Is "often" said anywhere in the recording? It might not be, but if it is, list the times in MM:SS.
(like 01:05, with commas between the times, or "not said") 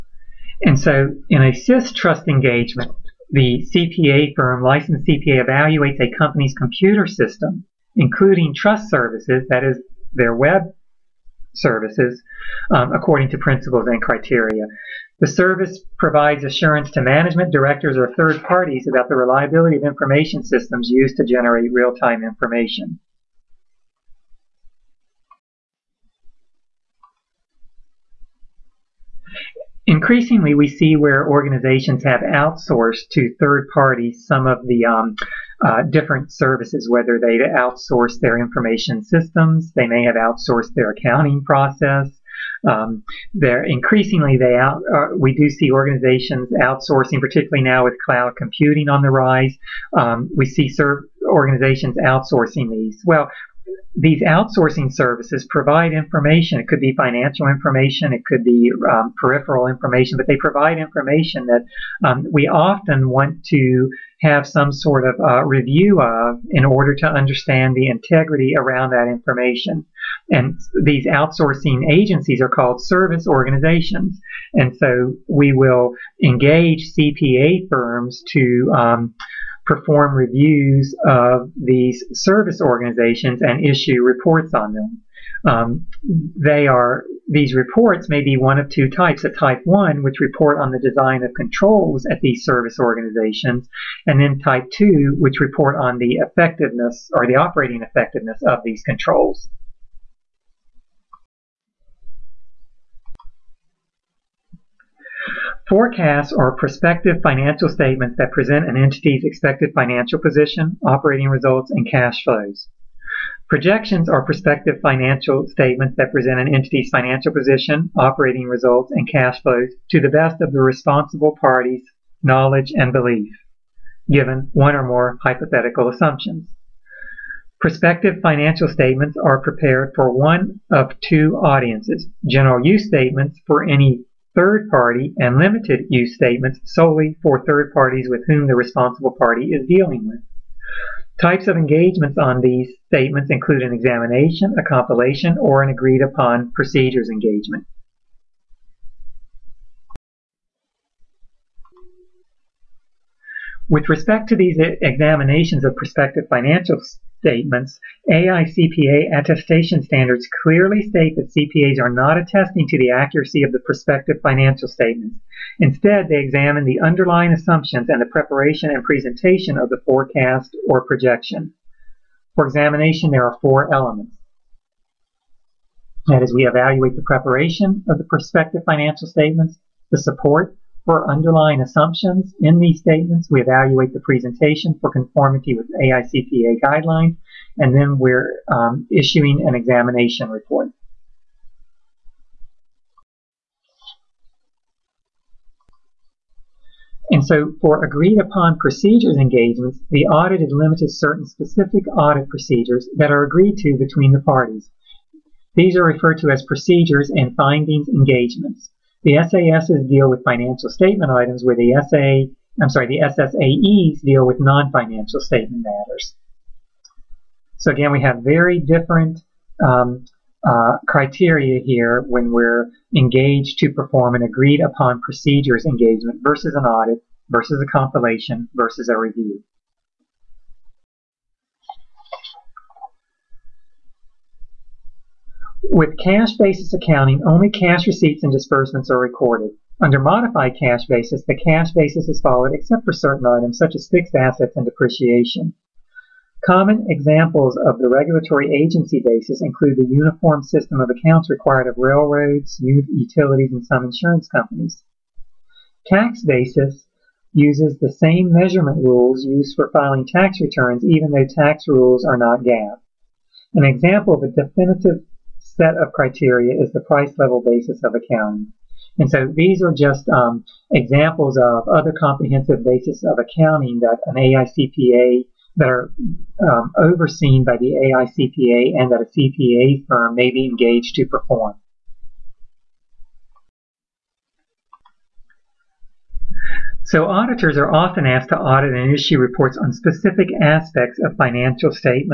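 01:02, 04:47.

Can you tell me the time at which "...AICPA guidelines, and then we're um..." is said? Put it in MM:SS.
03:05.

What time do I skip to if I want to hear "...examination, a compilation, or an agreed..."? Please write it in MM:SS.
02:23.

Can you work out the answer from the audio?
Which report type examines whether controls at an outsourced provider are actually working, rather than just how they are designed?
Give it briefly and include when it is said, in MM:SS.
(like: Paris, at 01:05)
type two, at 01:34.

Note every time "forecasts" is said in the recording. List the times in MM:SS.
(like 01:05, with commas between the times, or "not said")
01:45, 02:49.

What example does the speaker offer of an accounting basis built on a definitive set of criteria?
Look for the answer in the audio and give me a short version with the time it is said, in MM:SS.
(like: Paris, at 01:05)
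price level basis, at 04:26.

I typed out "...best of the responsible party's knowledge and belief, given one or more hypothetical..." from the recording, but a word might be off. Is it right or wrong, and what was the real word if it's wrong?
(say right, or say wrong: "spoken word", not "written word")
right.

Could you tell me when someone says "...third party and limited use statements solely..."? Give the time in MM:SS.
02:14.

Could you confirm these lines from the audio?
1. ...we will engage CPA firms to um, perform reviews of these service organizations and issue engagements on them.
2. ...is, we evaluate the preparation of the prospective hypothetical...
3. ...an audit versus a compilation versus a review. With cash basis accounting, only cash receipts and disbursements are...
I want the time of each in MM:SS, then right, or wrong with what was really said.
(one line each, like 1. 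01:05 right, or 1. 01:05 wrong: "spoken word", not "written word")
1. 01:15 wrong: "reports", not "engagements"
2. 02:56 wrong: "financial", not "hypothetical"
3. 03:46 right.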